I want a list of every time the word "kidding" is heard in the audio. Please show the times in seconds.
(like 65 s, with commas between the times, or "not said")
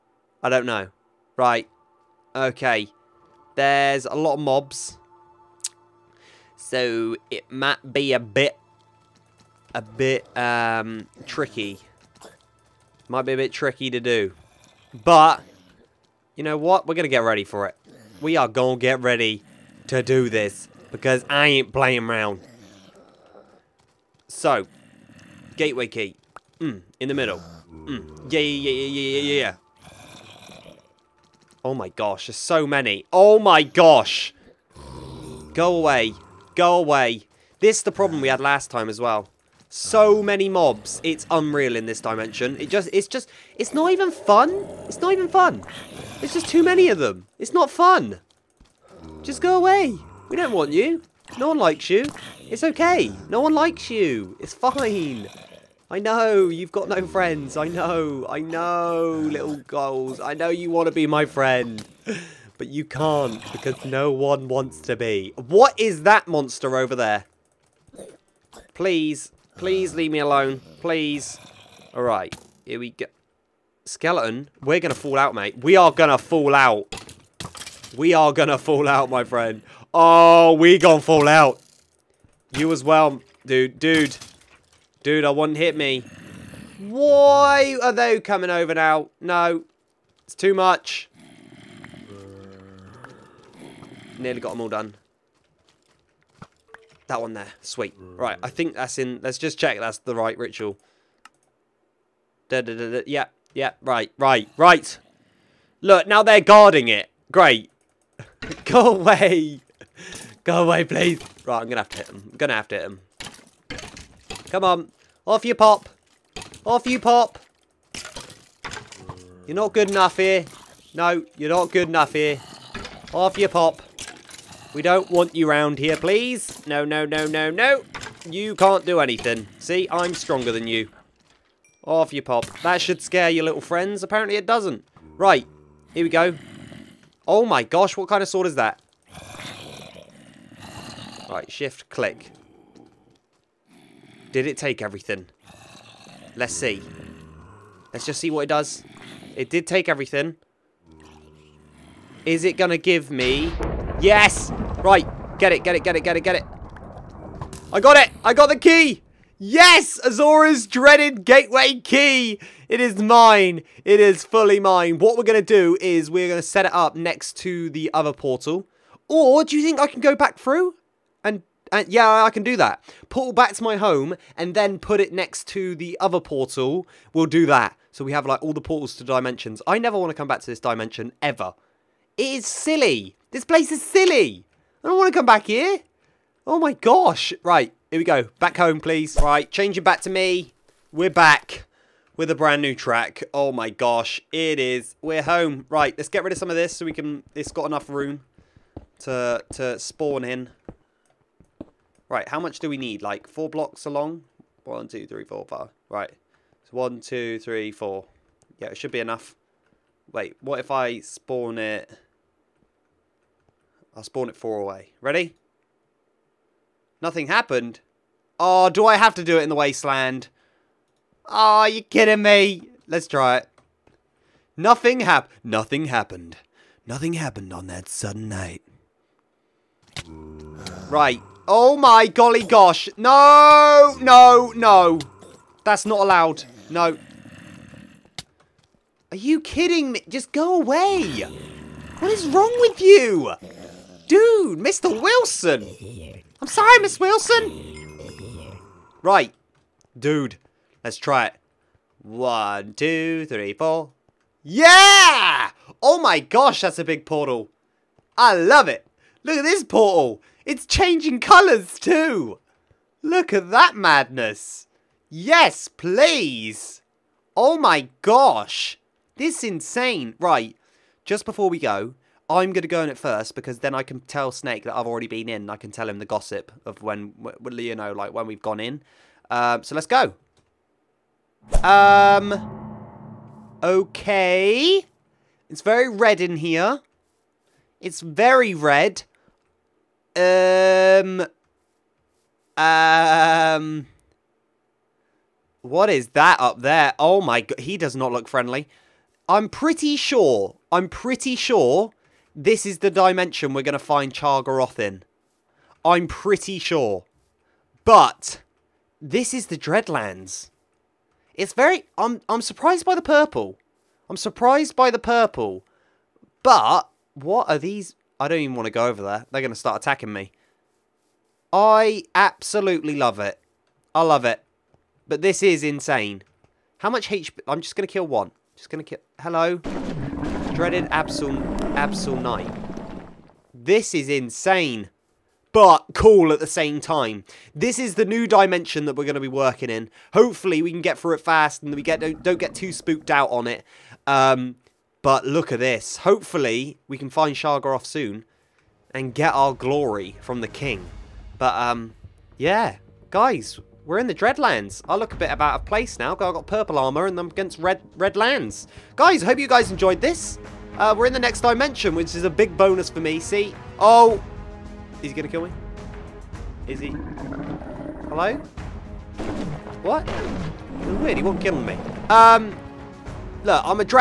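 221 s, 239 s.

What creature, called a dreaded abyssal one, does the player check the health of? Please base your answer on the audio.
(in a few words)
Abyssal Knight.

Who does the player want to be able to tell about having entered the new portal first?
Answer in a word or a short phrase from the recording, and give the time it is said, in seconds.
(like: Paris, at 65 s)
Snake, at 274 s.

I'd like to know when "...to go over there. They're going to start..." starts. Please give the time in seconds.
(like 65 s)
318 s.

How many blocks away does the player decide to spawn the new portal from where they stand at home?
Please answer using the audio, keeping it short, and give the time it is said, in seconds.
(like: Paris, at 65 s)
4, at 214 s.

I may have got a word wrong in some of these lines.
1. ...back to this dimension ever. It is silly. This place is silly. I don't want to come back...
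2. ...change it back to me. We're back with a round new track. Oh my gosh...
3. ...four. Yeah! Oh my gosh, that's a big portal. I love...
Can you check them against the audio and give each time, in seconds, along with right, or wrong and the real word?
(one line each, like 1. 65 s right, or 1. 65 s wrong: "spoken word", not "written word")
1. 180 s right
2. 189 s wrong: "brand", not "round"
3. 253 s right.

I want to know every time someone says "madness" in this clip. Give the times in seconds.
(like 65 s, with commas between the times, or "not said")
263 s.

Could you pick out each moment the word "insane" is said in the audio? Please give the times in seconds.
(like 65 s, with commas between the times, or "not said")
269 s, 325 s, 334 s.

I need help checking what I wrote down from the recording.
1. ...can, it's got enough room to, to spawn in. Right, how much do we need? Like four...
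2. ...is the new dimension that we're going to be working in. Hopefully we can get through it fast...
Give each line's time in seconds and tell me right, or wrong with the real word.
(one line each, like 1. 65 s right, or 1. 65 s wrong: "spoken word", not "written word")
1. 196 s right
2. 337 s right.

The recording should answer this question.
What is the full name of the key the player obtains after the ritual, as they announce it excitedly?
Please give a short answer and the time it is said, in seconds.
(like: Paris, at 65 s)
Asorah's dreaded gateway key, at 160 s.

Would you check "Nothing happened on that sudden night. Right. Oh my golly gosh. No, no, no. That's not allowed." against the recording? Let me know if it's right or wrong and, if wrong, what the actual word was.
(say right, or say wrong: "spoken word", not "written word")
right.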